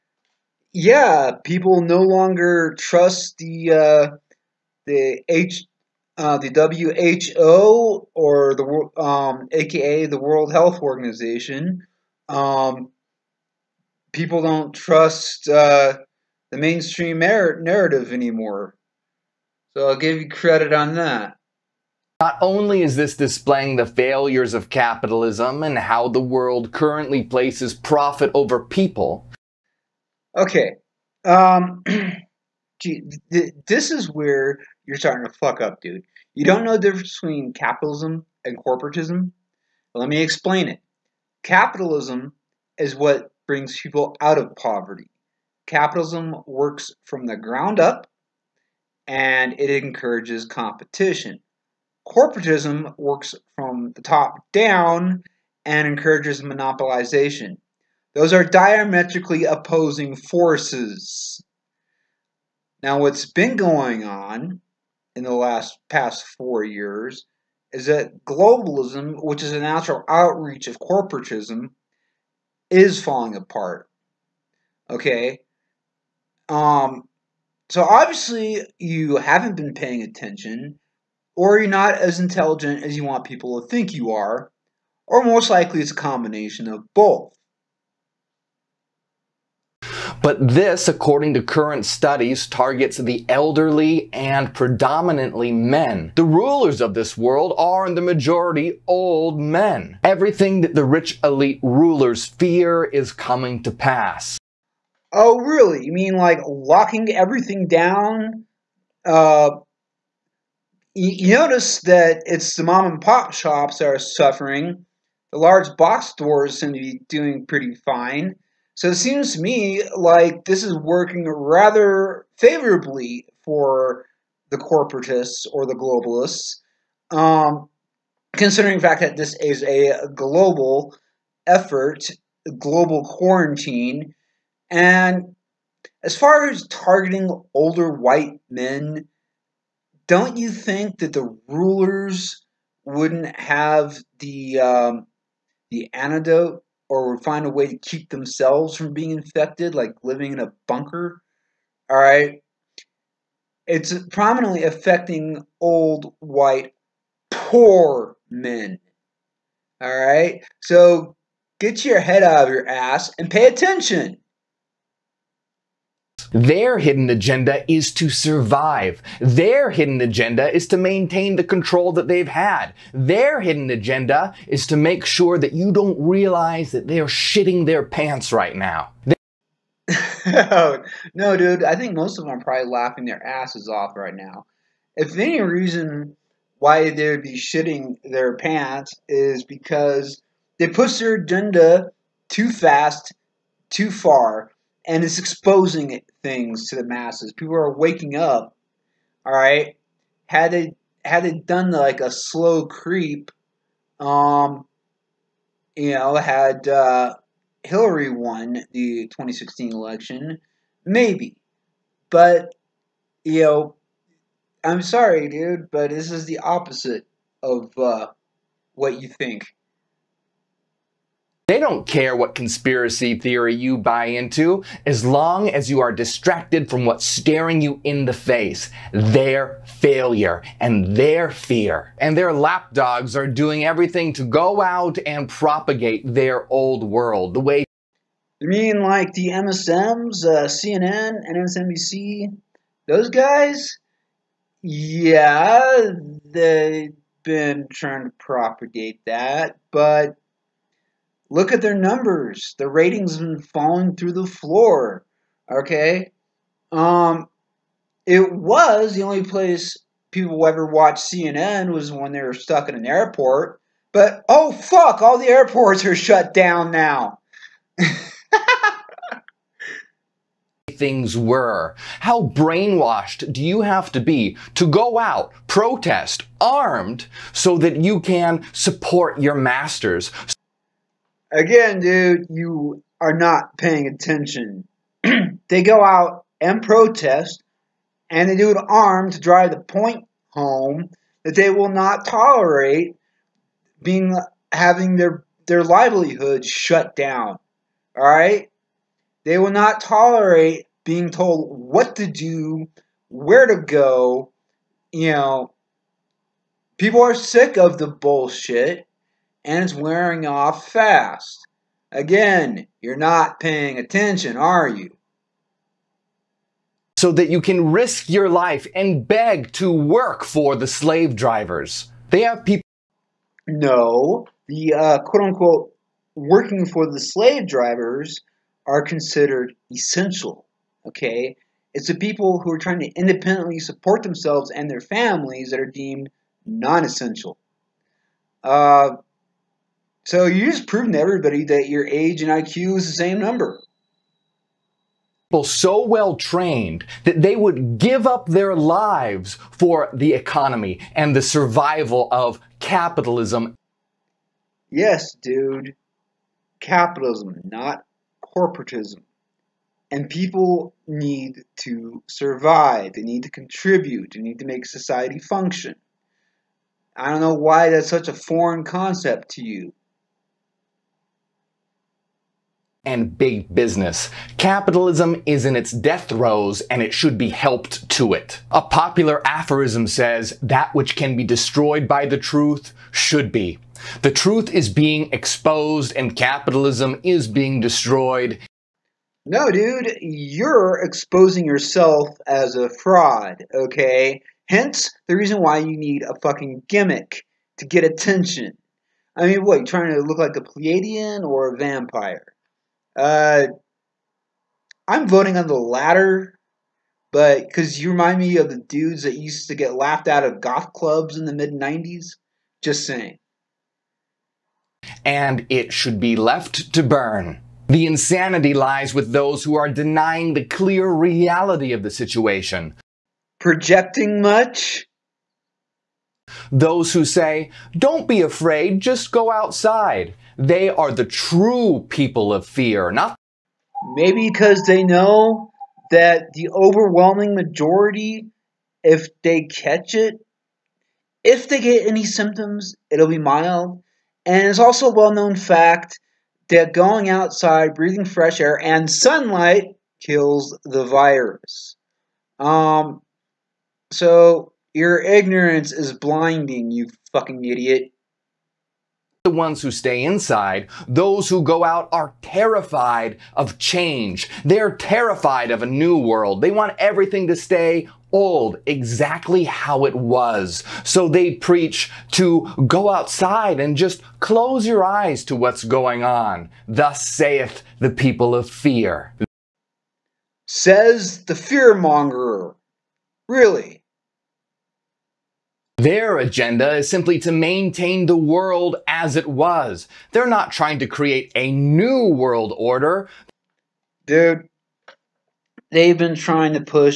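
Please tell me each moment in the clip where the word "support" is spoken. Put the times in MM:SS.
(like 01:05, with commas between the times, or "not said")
04:38, 05:33.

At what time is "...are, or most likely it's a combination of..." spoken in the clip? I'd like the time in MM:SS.
01:24.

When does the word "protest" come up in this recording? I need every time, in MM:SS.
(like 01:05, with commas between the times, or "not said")
04:35, 04:46.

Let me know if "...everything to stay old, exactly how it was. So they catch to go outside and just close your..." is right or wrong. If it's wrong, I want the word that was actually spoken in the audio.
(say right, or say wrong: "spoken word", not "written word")
wrong: "preach", not "catch".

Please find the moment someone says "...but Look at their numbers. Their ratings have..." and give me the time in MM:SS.
04:09.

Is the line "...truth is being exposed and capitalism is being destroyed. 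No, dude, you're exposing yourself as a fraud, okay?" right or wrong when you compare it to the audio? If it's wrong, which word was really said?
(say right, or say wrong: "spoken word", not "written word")
right.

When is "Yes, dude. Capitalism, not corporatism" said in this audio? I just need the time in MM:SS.
05:54.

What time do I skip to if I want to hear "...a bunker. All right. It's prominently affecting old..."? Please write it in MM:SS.
02:30.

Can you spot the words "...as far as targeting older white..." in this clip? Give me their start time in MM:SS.
02:16.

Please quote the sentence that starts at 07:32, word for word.
Um, so your ignorance is blinding, you fucking idiot.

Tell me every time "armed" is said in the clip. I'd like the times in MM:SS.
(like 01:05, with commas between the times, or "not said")
04:36, 04:48.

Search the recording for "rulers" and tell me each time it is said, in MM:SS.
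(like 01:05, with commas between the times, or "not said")
01:36, 01:41, 02:21.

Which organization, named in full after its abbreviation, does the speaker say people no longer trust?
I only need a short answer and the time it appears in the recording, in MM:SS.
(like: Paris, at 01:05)
World Health Organization, at 00:10.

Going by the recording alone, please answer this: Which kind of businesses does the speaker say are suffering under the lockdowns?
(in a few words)
Mom and pop shops.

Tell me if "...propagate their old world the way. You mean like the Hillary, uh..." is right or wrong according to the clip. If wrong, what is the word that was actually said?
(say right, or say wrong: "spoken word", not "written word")
wrong: "MSMs", not "Hillary".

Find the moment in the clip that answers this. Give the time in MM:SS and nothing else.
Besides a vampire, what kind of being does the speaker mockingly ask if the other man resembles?
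06:40.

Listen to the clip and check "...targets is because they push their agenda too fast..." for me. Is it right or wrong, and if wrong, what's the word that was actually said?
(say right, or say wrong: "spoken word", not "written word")
wrong: "pants", not "targets".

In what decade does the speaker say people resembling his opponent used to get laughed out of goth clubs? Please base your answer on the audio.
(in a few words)
Mid 90s.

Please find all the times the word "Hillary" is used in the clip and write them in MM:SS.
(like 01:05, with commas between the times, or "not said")
03:27.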